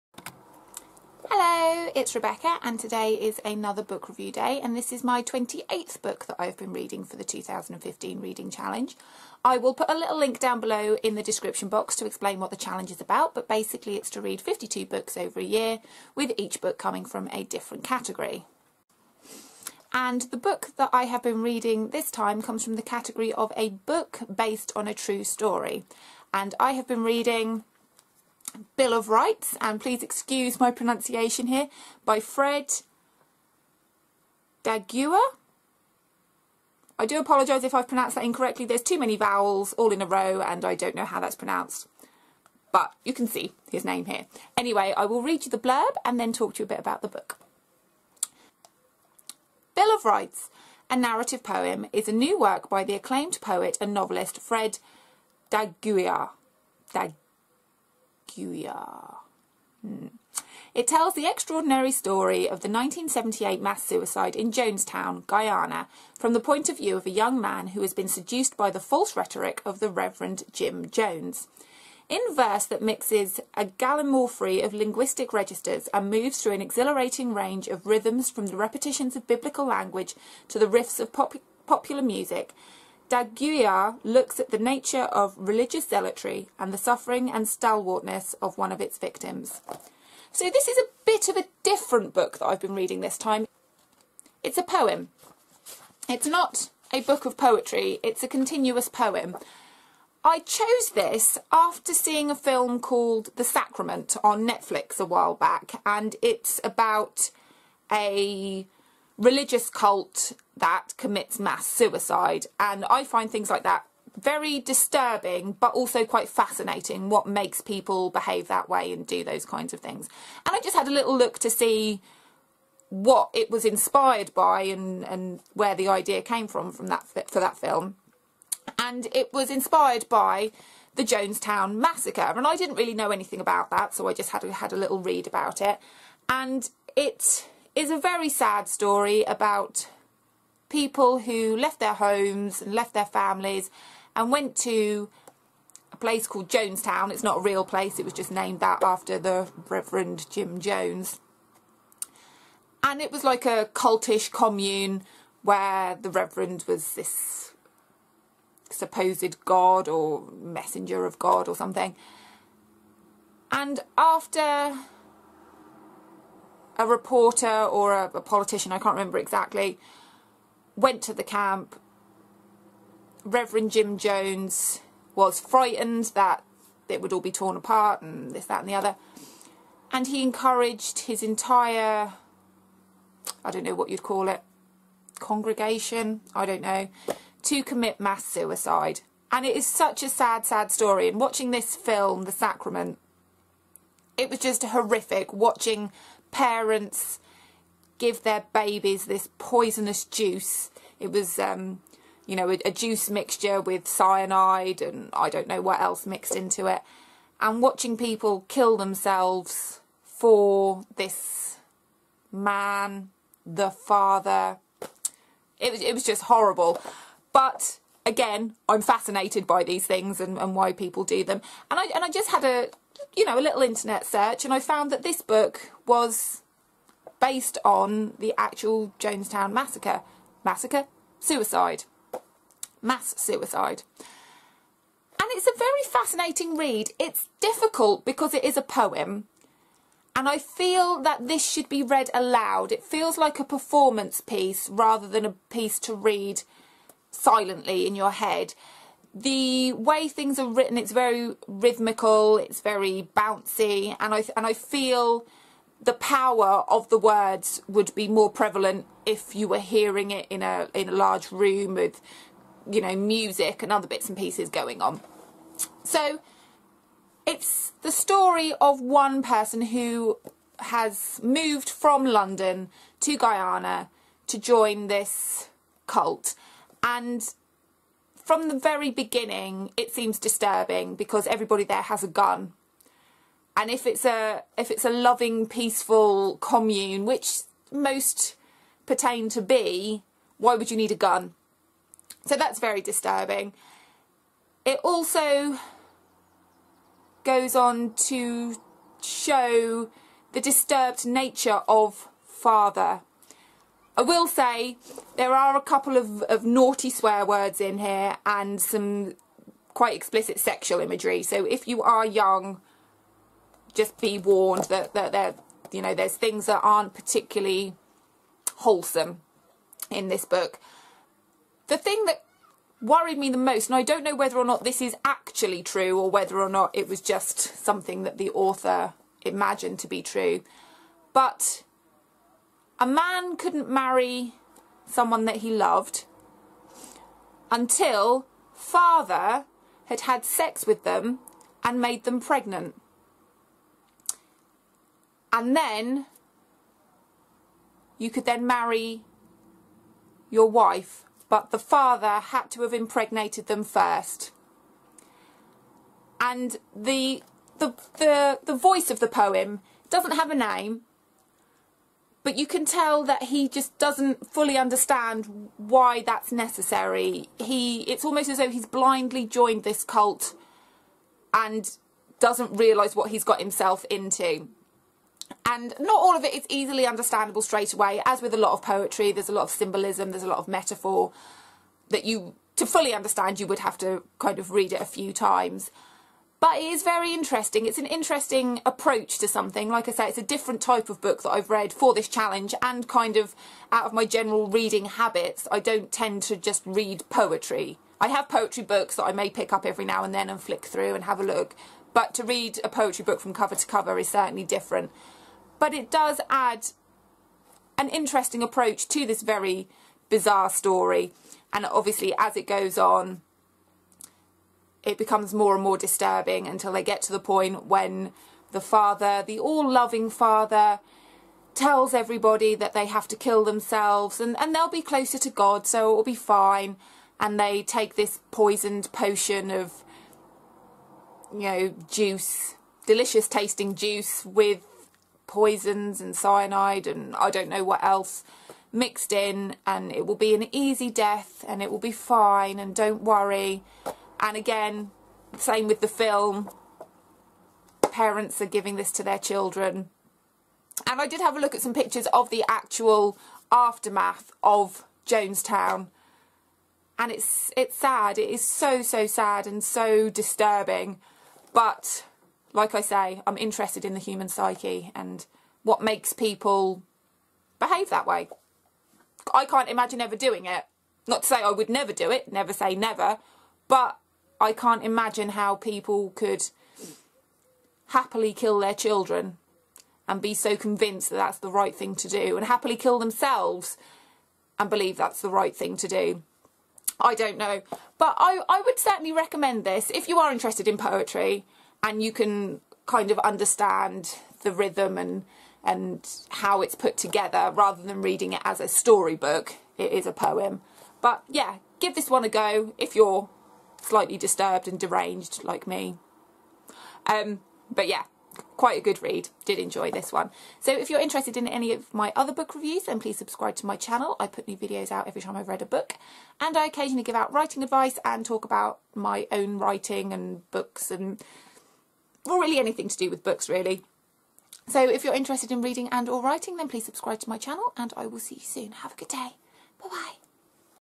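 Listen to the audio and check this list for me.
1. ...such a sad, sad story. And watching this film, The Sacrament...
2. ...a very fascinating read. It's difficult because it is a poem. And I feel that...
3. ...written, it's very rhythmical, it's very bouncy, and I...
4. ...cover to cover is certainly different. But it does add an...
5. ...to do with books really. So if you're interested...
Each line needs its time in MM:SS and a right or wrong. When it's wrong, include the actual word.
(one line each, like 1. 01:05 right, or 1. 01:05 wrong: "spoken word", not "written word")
1. 03:09 right
2. 03:55 right
3. 04:10 right
4. 06:43 right
5. 08:42 right.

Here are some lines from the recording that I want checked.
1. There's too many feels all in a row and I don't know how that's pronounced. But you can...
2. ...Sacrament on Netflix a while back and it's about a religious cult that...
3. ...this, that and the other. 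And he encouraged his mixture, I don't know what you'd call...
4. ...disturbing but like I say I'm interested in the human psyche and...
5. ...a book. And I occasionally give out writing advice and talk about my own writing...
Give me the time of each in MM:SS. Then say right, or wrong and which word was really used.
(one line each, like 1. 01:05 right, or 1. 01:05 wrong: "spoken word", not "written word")
1. 00:38 wrong: "vowels", not "feels"
2. 01:43 right
3. 02:58 wrong: "entire", not "mixture"
4. 07:40 right
5. 08:35 right.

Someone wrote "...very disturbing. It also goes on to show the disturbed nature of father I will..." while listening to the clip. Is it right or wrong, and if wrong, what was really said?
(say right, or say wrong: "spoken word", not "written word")
right.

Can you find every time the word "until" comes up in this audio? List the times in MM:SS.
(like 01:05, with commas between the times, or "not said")
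05:37, 06:56.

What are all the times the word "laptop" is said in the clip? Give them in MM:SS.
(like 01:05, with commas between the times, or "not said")
not said.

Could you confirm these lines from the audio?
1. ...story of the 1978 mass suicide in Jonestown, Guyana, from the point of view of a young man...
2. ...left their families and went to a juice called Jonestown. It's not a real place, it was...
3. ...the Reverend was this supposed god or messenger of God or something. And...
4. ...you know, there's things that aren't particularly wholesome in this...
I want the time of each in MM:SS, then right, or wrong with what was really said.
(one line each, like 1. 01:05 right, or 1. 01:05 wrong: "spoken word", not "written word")
1. 01:01 right
2. 02:22 wrong: "place", not "juice"
3. 02:35 right
4. 05:15 right.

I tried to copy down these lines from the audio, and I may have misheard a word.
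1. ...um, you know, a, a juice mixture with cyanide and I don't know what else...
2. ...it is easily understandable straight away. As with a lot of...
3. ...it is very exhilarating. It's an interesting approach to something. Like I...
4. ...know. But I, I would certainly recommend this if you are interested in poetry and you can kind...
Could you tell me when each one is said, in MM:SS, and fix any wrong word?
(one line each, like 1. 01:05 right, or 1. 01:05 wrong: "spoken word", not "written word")
1. 03:21 right
2. 06:16 right
3. 06:26 wrong: "interesting", not "exhilarating"
4. 08:07 right.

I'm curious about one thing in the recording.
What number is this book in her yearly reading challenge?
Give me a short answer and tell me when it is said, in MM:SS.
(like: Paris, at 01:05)
28th, at 00:05.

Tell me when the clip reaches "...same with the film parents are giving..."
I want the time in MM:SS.
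07:25.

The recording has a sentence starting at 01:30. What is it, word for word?
So this is a bit of a different book that I've been reading this time.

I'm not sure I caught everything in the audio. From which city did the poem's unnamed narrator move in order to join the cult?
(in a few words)
London.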